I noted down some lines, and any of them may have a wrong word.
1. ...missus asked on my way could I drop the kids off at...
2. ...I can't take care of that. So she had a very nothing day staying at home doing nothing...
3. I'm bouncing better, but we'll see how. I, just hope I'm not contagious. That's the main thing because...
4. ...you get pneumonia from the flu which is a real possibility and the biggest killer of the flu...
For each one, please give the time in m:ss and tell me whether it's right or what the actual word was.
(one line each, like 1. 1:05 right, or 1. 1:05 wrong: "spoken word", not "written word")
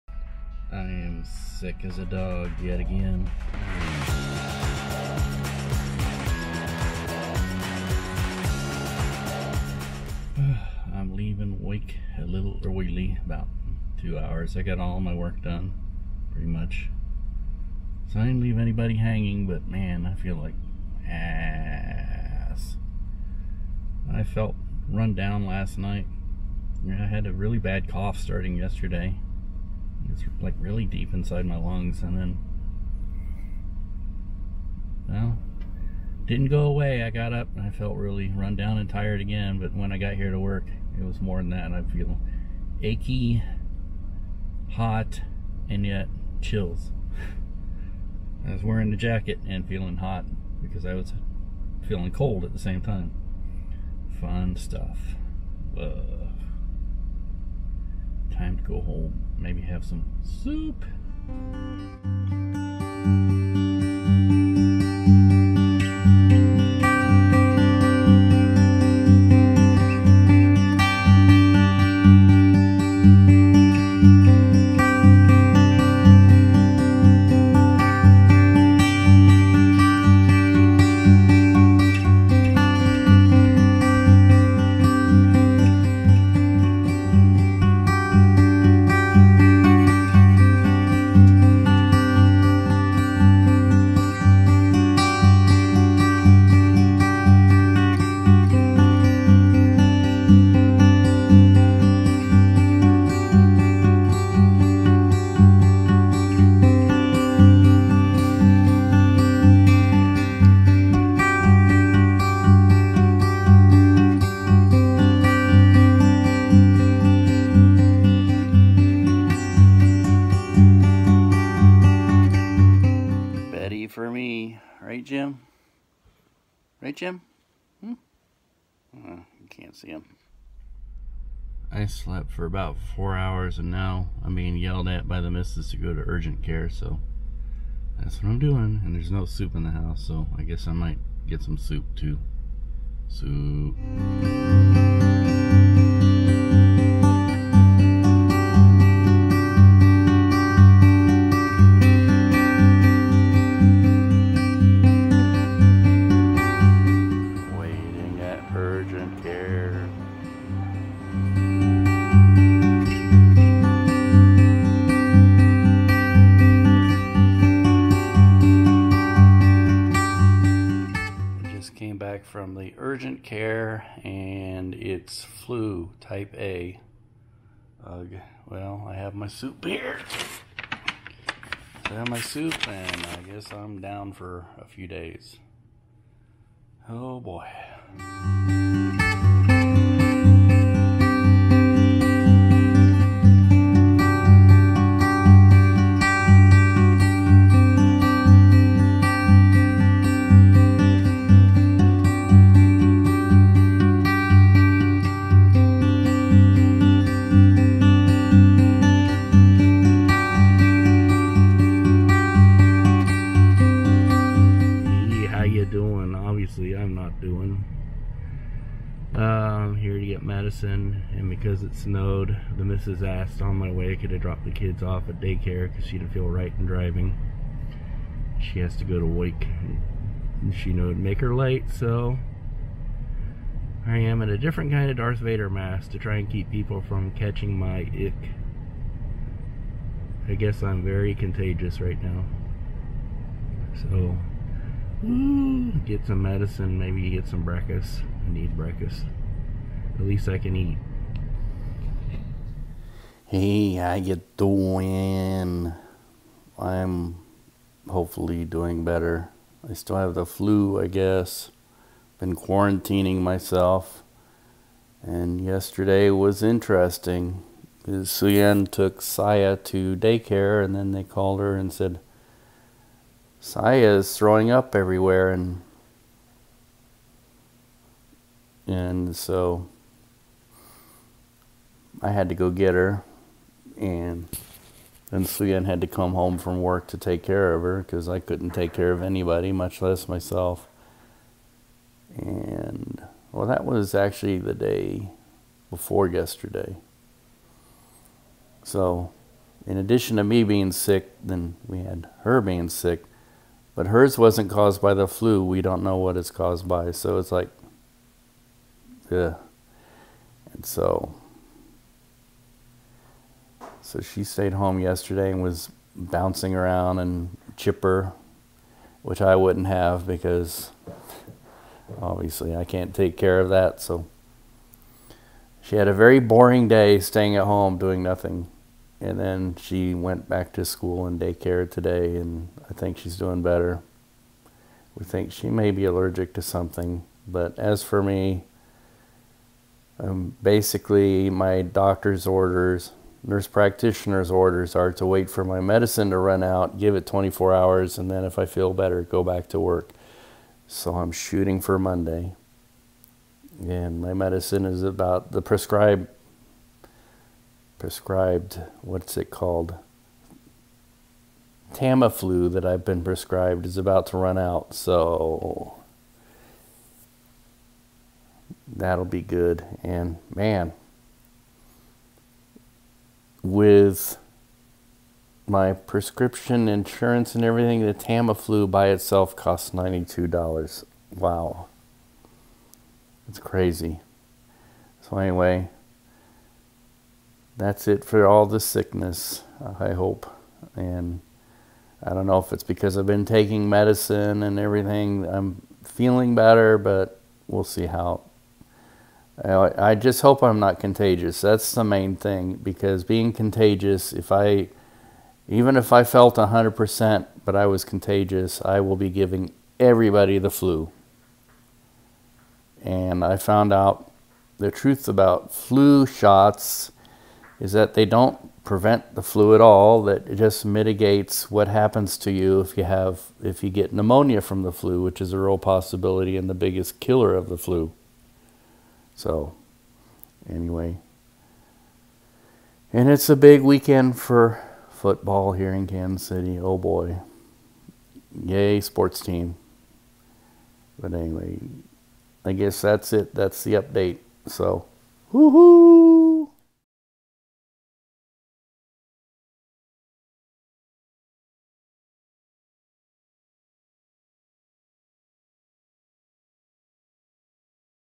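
1. 3:42 right
2. 5:22 wrong: "boring", not "nothing"
3. 6:35 wrong: "feeling", not "bouncing"
4. 7:03 right.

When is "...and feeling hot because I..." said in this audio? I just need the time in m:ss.
0:49.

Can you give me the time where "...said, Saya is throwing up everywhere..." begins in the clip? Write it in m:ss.
4:31.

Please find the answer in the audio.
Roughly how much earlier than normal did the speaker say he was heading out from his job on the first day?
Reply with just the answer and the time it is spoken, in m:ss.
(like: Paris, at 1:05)
2 hours, at 0:14.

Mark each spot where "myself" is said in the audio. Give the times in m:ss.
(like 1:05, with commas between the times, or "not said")
4:23, 4:50.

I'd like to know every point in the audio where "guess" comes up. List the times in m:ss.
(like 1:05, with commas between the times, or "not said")
2:20, 3:03, 4:00, 4:20, 7:22.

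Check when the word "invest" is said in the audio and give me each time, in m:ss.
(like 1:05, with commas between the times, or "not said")
not said.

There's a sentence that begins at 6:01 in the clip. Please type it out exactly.
Tamiflu that I've been prescribed is about to run out, so that'll be good.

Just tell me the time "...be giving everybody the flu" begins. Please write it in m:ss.
6:48.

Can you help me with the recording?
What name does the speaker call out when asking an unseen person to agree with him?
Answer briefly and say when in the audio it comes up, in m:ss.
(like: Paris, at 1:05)
Jim, at 2:06.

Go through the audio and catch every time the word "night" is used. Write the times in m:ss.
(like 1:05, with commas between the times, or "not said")
0:25.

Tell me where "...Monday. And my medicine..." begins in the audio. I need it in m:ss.
5:51.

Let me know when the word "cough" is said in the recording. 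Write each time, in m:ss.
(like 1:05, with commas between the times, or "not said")
0:27.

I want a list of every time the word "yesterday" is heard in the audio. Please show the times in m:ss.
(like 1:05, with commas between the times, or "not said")
0:28, 4:25, 4:56, 5:14.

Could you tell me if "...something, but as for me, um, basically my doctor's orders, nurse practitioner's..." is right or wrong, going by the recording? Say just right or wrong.
right.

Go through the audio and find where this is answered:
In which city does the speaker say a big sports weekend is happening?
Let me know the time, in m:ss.
7:15.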